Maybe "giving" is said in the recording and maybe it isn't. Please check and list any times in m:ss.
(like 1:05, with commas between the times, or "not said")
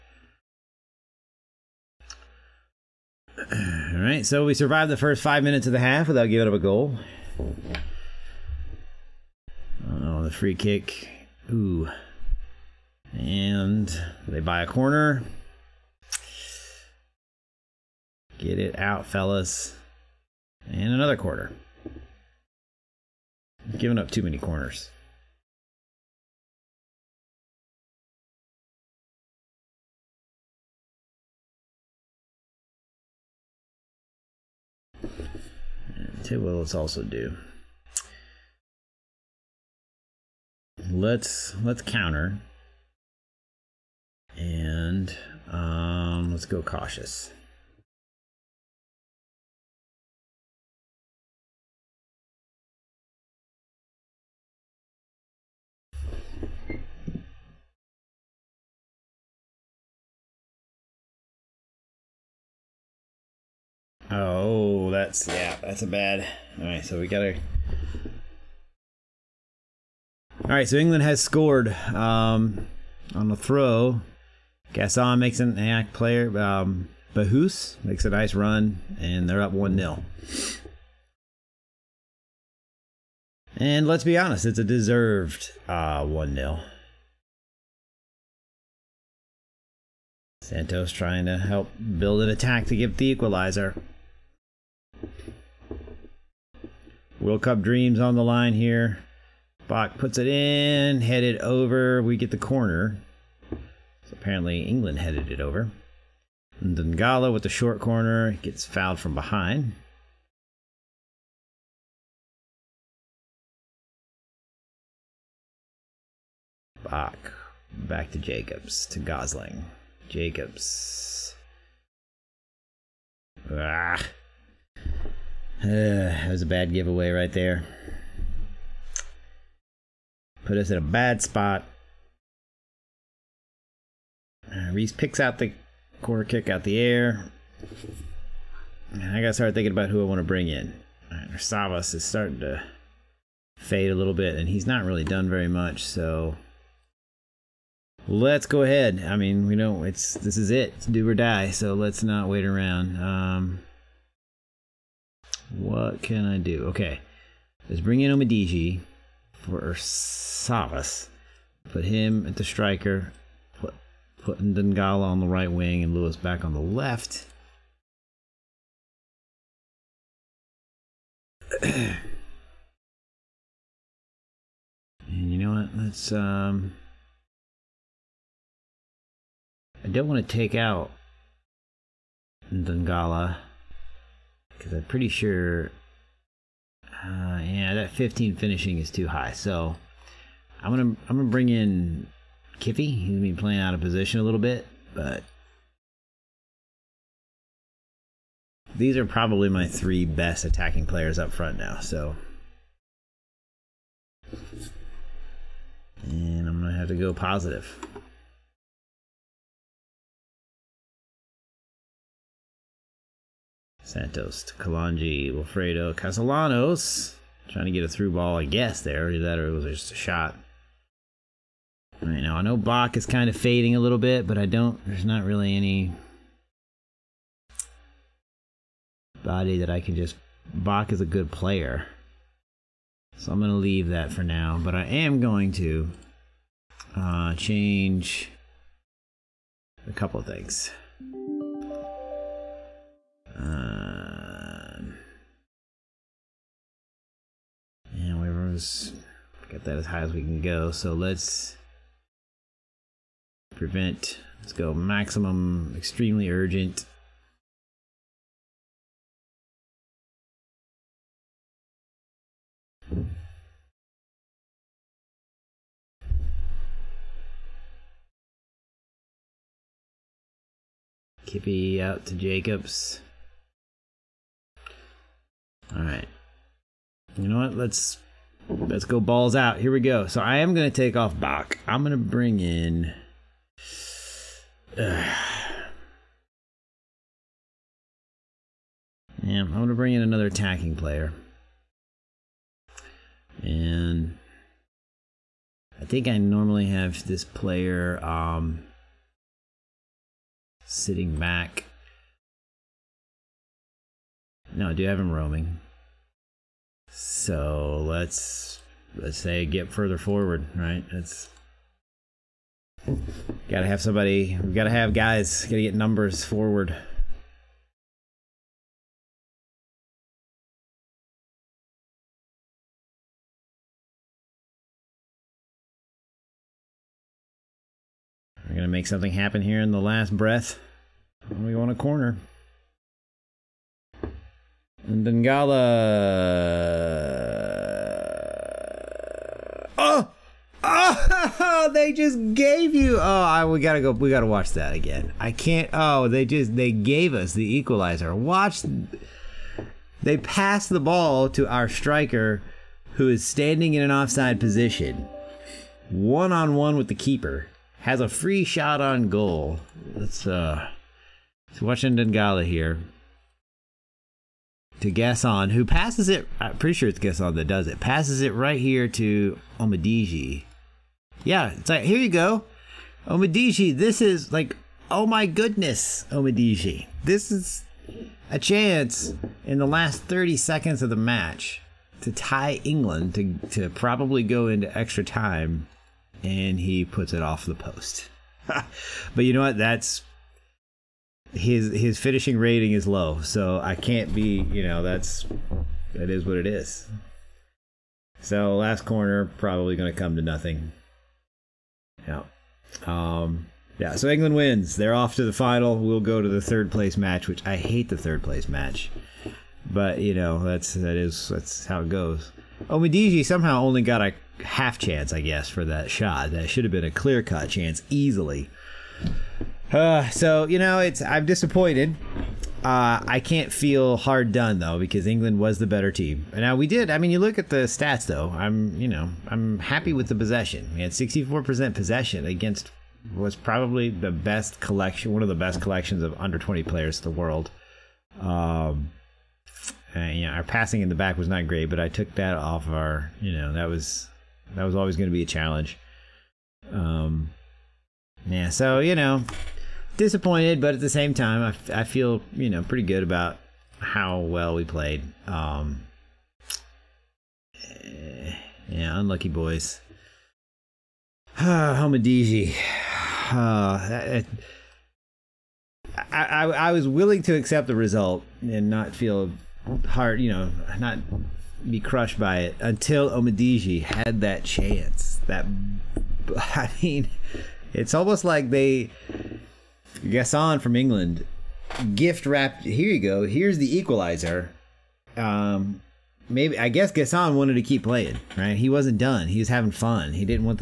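0:06, 0:23.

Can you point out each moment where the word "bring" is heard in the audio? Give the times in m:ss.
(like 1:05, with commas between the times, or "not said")
2:20, 2:37, 3:11, 4:41, 4:49.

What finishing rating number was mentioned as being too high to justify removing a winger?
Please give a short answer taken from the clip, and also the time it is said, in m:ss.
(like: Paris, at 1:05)
15, at 3:07.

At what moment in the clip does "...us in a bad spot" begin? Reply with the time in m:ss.
2:10.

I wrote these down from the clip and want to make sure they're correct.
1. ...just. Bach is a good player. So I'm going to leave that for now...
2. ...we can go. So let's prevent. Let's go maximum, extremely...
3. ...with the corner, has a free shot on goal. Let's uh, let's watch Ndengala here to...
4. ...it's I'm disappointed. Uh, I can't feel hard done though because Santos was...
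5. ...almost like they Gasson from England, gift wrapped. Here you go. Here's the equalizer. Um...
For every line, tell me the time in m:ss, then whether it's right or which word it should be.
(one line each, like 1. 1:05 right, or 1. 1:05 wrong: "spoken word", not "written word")
1. 3:49 right
2. 4:10 right
3. 5:56 wrong: "keeper", not "corner"
4. 7:00 wrong: "England", not "Santos"
5. 7:57 right.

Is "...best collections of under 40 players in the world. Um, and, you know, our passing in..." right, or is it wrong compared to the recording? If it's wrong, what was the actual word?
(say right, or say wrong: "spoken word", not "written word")
wrong: "20", not "40".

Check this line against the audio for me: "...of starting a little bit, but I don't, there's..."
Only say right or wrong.
wrong.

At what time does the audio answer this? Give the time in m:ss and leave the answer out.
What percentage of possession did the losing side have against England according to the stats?
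7:10.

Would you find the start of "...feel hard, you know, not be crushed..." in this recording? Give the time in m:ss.
7:48.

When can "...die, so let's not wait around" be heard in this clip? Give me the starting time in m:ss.
2:31.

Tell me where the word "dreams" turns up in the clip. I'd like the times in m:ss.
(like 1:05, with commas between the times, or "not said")
1:37.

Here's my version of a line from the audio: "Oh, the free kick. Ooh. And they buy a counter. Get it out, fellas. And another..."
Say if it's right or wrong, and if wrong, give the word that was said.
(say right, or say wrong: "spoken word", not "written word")
wrong: "corner", not "counter".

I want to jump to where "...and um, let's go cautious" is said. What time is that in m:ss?
0:44.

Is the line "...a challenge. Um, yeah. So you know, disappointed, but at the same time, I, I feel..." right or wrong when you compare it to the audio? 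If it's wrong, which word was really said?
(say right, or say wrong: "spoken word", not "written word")
right.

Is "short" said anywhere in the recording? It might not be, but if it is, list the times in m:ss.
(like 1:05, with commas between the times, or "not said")
1:47.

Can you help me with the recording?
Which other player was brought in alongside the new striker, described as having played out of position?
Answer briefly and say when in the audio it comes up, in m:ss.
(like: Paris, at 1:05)
Kiffy, at 3:12.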